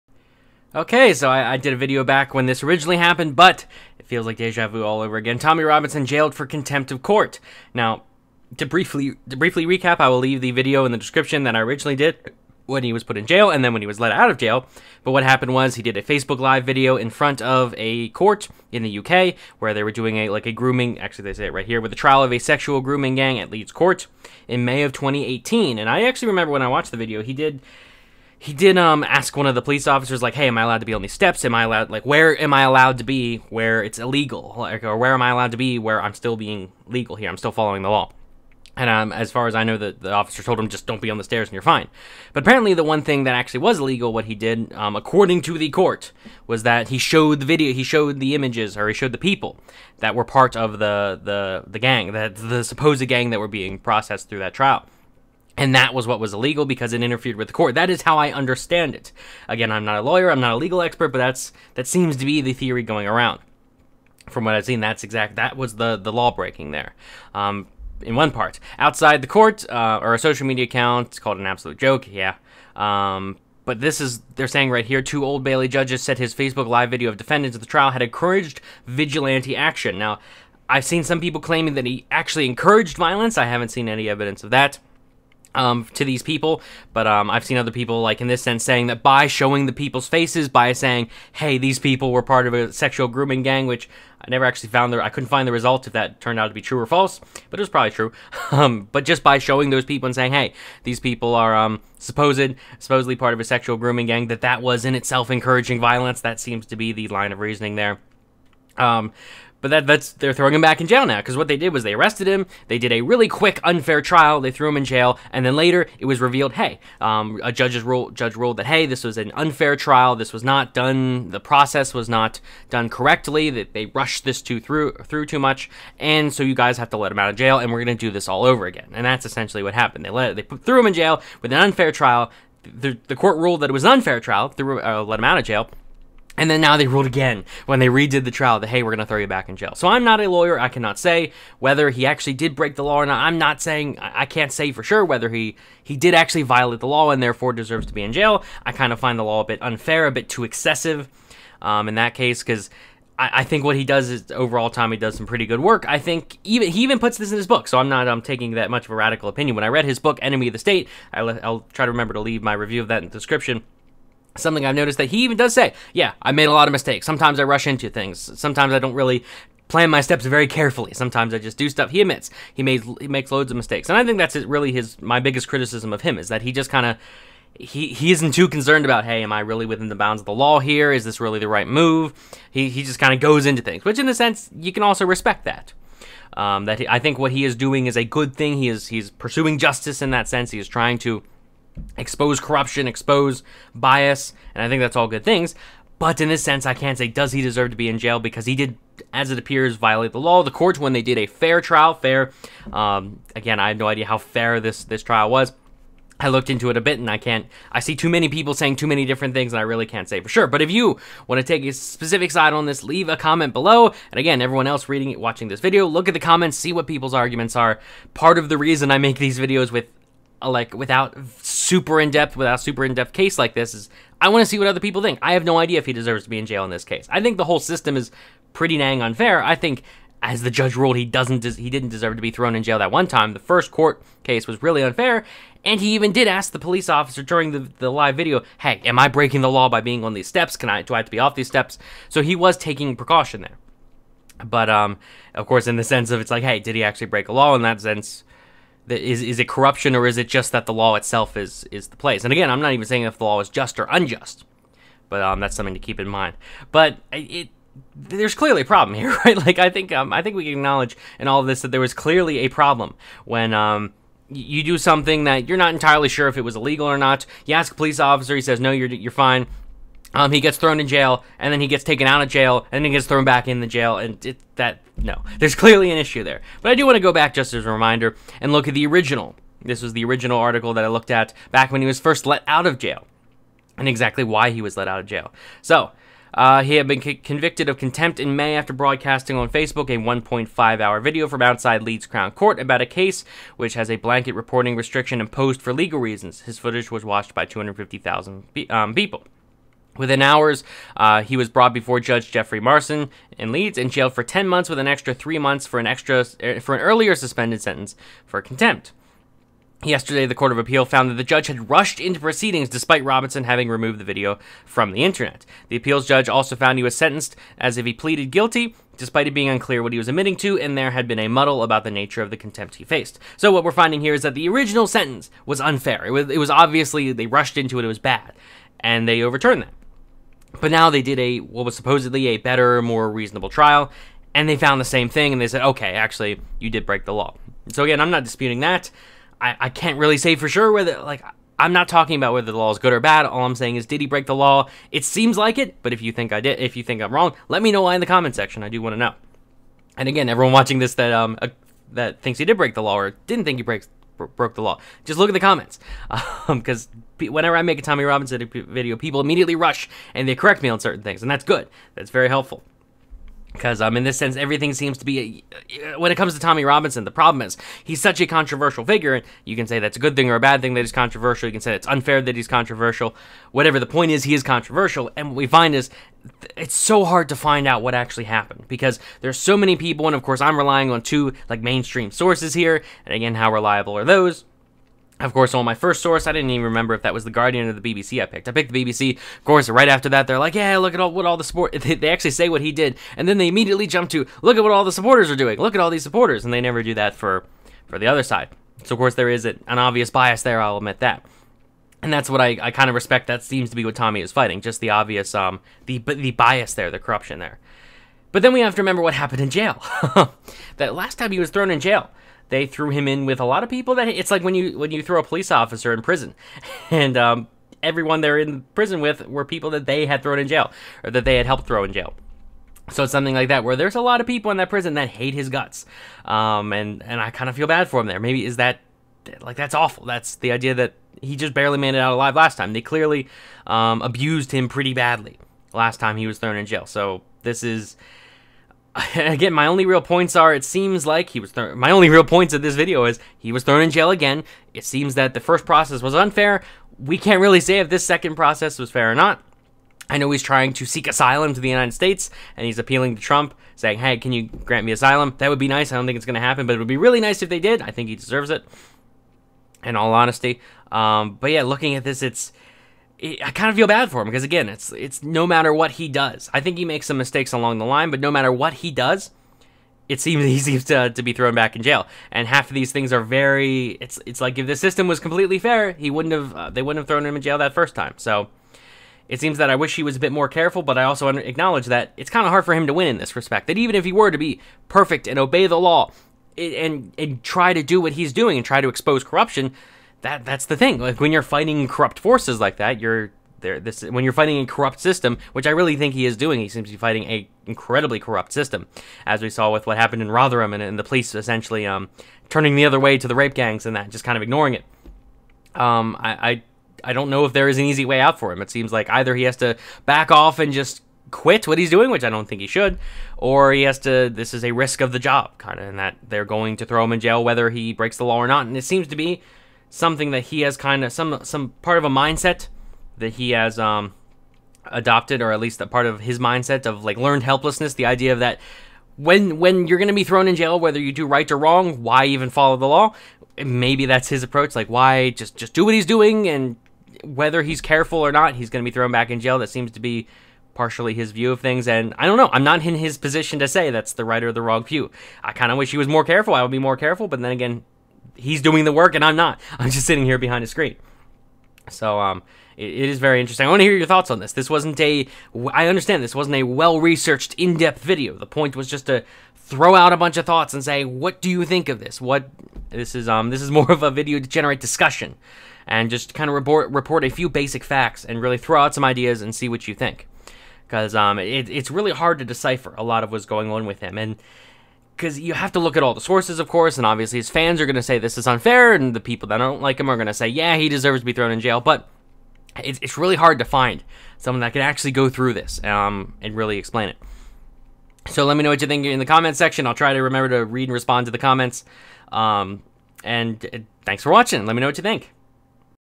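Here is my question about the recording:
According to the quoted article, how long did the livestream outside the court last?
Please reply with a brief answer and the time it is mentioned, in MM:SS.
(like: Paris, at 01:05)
1.5 hours, at 04:49.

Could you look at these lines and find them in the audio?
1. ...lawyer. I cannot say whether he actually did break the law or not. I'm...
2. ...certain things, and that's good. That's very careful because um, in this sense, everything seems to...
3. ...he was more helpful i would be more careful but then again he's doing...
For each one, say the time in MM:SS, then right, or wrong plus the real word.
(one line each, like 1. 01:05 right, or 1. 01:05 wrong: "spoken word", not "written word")
1. 02:20 right
2. 06:00 wrong: "helpful", not "careful"
3. 09:05 wrong: "careful", not "helpful".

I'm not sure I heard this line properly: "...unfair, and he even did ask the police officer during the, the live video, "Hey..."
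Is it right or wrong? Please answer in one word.
right.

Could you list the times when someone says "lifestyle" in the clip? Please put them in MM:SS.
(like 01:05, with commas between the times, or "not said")
not said.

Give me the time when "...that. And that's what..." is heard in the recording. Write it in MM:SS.
06:40.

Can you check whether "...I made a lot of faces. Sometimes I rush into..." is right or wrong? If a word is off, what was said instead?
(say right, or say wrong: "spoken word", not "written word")
wrong: "mistakes", not "faces".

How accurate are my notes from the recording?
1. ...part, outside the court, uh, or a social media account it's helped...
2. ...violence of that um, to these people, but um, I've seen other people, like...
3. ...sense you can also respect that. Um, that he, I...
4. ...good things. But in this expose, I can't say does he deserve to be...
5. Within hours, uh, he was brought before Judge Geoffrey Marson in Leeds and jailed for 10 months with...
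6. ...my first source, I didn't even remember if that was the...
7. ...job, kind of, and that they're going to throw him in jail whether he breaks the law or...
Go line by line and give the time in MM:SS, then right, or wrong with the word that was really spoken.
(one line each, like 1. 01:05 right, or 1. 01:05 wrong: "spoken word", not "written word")
1. 01:08 wrong: "called", not "helped"
2. 01:24 wrong: "evidence", not "violence"
3. 03:04 right
4. 03:15 wrong: "sense", not "expose"
5. 04:59 right
6. 06:25 right
7. 08:35 right.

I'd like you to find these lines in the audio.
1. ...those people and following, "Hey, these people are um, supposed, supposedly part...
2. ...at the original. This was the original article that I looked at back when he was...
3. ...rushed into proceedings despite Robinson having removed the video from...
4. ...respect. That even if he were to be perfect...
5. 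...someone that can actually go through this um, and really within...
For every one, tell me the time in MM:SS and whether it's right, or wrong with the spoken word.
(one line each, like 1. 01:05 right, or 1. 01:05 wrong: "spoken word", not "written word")
1. 01:39 wrong: "saying", not "following"
2. 04:38 right
3. 05:11 right
4. 08:03 right
5. 09:44 wrong: "explain", not "within".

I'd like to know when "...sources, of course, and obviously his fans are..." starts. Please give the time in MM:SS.
09:36.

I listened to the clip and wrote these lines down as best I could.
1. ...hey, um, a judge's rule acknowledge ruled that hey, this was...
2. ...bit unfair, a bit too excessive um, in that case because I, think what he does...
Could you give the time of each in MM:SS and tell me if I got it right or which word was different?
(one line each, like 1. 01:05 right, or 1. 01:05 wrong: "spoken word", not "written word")
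1. 01:56 wrong: "judge", not "acknowledge"
2. 02:29 right.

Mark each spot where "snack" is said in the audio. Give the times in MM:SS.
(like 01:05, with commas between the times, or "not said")
not said.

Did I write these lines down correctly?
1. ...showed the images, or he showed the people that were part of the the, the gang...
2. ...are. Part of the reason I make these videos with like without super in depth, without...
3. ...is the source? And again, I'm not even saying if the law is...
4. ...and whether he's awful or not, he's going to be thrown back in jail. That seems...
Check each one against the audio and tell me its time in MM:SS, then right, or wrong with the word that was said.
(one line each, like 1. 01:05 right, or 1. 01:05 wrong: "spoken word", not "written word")
1. 00:47 right
2. 03:37 right
3. 04:11 wrong: "place", not "source"
4. 08:56 wrong: "careful", not "awful".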